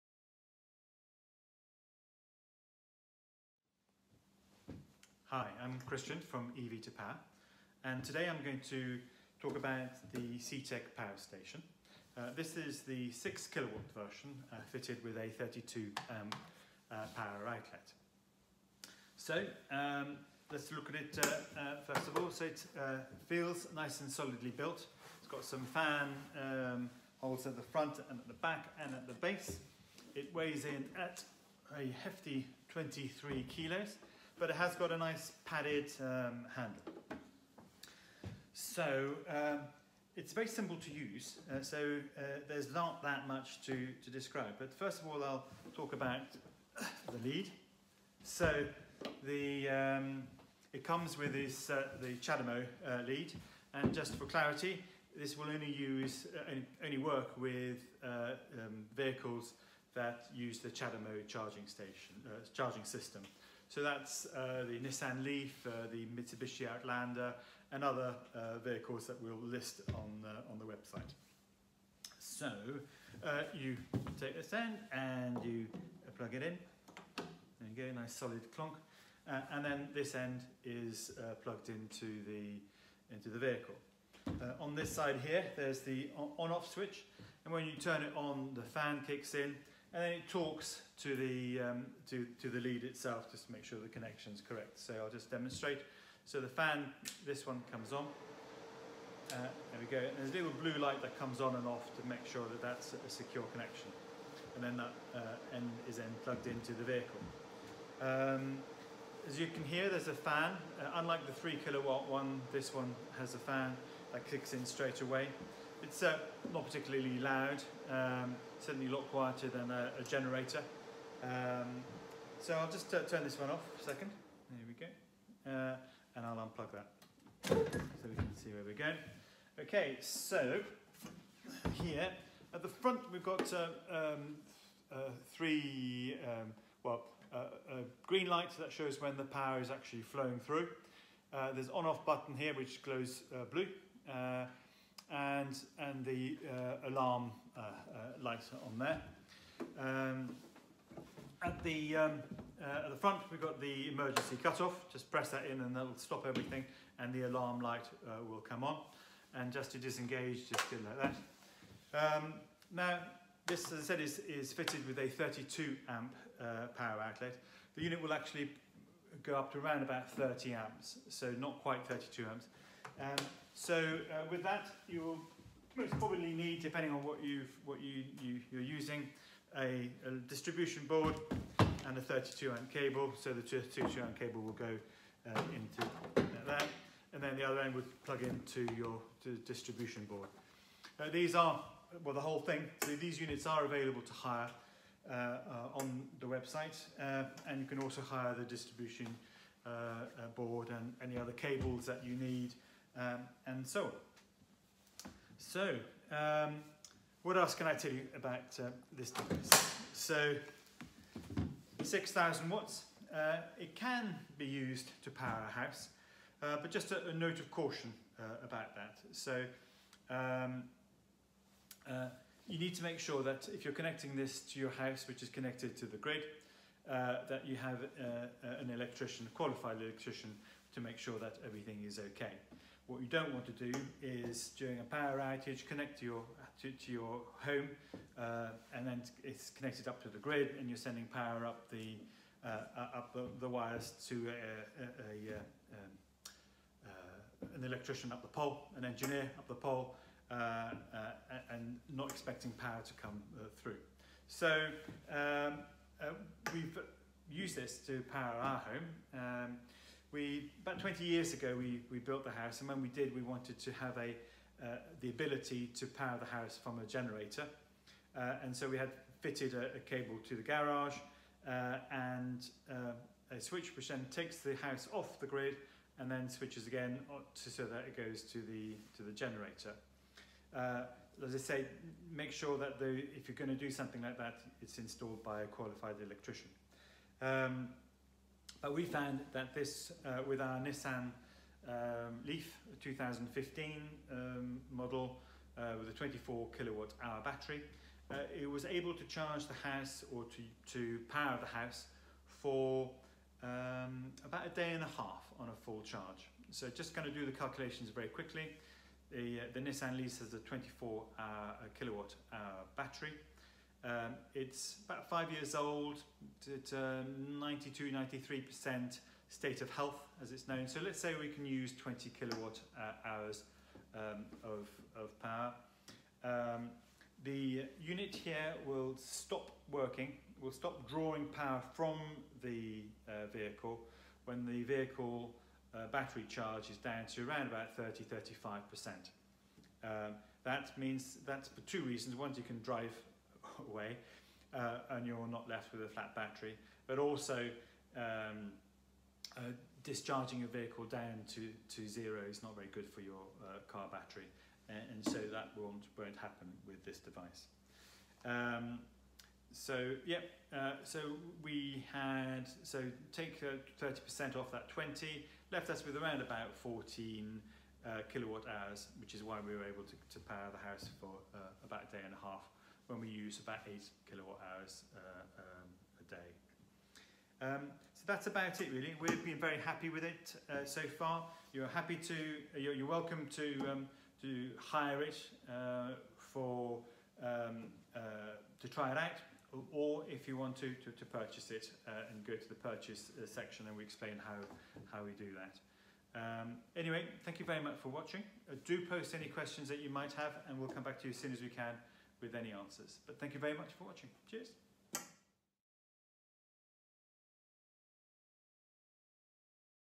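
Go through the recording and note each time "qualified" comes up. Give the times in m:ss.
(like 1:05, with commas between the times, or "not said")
3:49, 4:45.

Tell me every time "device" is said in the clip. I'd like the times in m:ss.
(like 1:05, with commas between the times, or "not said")
3:29, 5:56.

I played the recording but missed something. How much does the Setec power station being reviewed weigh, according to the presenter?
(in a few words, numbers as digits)
23 kilos.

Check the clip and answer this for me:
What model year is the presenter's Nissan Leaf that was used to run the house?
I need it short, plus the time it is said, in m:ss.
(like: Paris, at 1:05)
2015, at 4:52.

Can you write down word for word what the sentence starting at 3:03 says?
So the 32 amp cable will go uh, into that, And then the other end would plug into your distribution board.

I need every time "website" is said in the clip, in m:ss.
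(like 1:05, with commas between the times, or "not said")
1:10, 3:16.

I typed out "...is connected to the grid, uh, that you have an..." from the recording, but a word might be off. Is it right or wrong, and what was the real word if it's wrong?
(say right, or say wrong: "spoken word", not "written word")
right.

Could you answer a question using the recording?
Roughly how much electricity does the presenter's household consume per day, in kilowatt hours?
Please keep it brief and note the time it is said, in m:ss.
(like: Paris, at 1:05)
8 kilowatt hours, at 6:13.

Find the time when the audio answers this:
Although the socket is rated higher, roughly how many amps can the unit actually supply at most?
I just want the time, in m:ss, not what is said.
2:50.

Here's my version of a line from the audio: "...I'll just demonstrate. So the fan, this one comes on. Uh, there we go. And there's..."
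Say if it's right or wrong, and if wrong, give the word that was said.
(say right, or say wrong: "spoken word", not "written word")
right.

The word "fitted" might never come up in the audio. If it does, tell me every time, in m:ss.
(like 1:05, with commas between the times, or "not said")
0:14, 2:44, 4:29.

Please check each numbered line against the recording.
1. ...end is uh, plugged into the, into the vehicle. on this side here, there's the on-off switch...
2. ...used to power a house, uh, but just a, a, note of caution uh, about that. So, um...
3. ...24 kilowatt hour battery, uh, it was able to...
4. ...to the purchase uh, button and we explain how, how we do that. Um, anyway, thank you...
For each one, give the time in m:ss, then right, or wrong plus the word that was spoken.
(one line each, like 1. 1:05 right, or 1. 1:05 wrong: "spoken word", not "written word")
1. 1:20 right
2. 3:34 right
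3. 4:55 right
4. 6:32 wrong: "section", not "button".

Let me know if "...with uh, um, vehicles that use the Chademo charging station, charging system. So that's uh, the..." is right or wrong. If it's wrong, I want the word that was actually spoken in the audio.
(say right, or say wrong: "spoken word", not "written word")
right.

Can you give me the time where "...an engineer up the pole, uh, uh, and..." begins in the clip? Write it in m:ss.
4:08.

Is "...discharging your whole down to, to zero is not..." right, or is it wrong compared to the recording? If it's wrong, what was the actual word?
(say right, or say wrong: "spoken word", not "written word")
wrong: "vehicle", not "whole".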